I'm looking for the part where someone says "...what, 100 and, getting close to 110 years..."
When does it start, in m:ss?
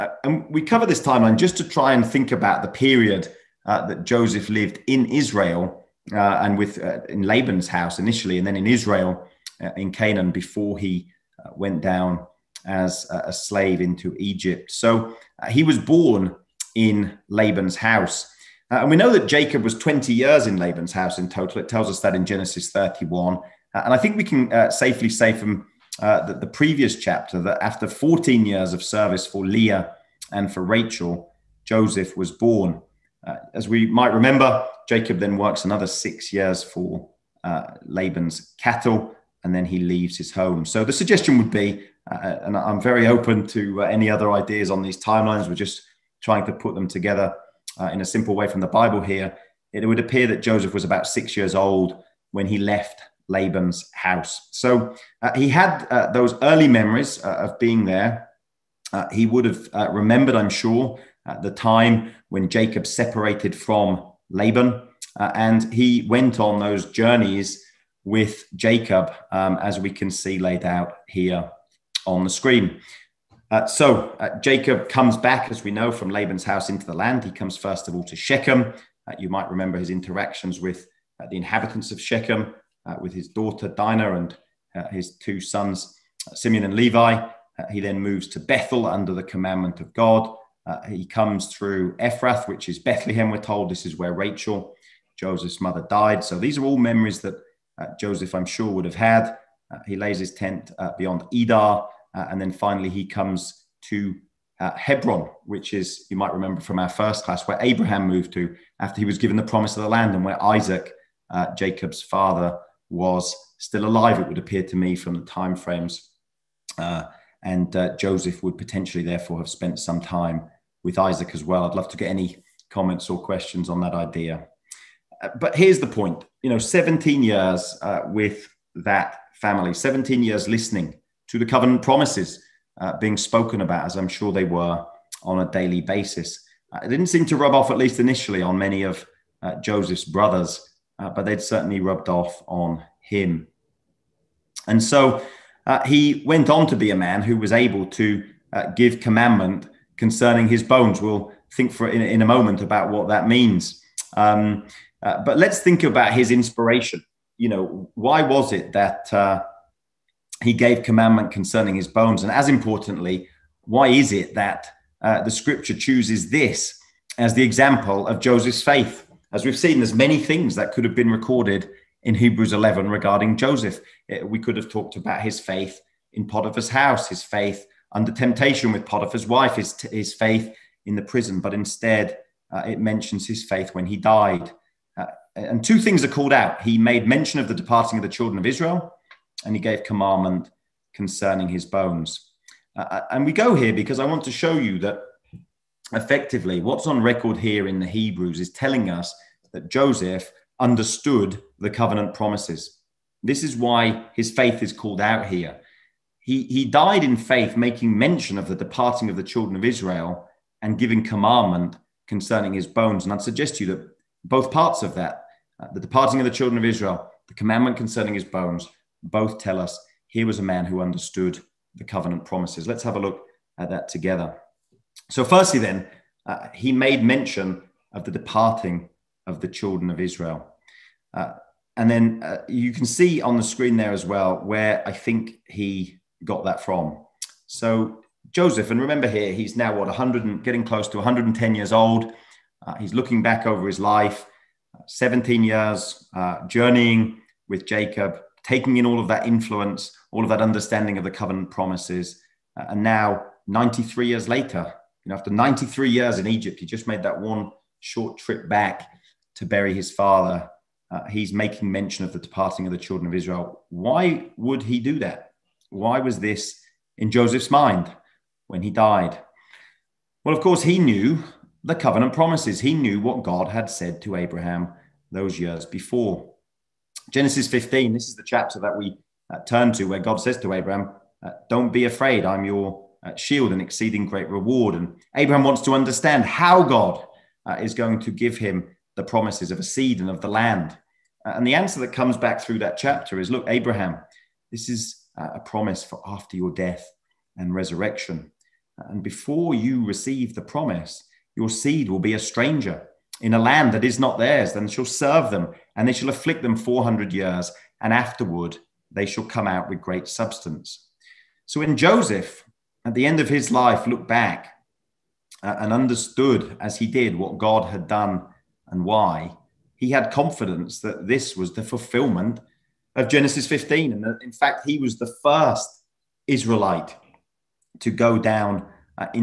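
3:59.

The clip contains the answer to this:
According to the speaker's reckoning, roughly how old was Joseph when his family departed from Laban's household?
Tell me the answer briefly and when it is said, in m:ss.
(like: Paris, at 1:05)
6, at 0:50.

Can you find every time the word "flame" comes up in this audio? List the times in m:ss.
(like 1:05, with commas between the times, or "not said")
not said.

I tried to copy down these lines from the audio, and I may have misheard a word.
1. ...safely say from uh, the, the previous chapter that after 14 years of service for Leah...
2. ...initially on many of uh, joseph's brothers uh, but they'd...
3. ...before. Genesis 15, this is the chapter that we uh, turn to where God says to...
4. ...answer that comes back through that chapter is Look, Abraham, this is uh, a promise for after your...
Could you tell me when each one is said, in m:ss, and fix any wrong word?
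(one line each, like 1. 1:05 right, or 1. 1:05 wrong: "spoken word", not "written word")
1. 0:24 right
2. 2:17 right
3. 4:35 right
4. 4:51 right.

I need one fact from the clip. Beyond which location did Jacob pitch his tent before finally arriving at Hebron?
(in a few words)
Edar.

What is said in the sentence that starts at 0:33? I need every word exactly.
Uh, as we might remember, Jacob then works another six years for uh, Laban's cattle and then he leaves his home.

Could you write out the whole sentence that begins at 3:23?
This is why his faith is called out here.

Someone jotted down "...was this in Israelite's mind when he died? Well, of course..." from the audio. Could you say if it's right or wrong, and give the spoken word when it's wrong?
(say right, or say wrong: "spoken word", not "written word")
wrong: "Joseph", not "Israelite".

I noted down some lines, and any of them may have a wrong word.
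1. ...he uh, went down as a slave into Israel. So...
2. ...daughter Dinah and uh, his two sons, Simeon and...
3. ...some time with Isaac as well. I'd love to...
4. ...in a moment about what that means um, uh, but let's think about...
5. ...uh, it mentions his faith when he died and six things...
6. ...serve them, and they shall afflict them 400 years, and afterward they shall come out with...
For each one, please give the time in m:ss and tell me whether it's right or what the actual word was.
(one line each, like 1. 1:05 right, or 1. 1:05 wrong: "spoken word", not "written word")
1. 0:10 wrong: "Egypt", not "Israel"
2. 1:23 right
3. 1:59 right
4. 2:32 right
5. 3:02 wrong: "two", not "six"
6. 5:04 right.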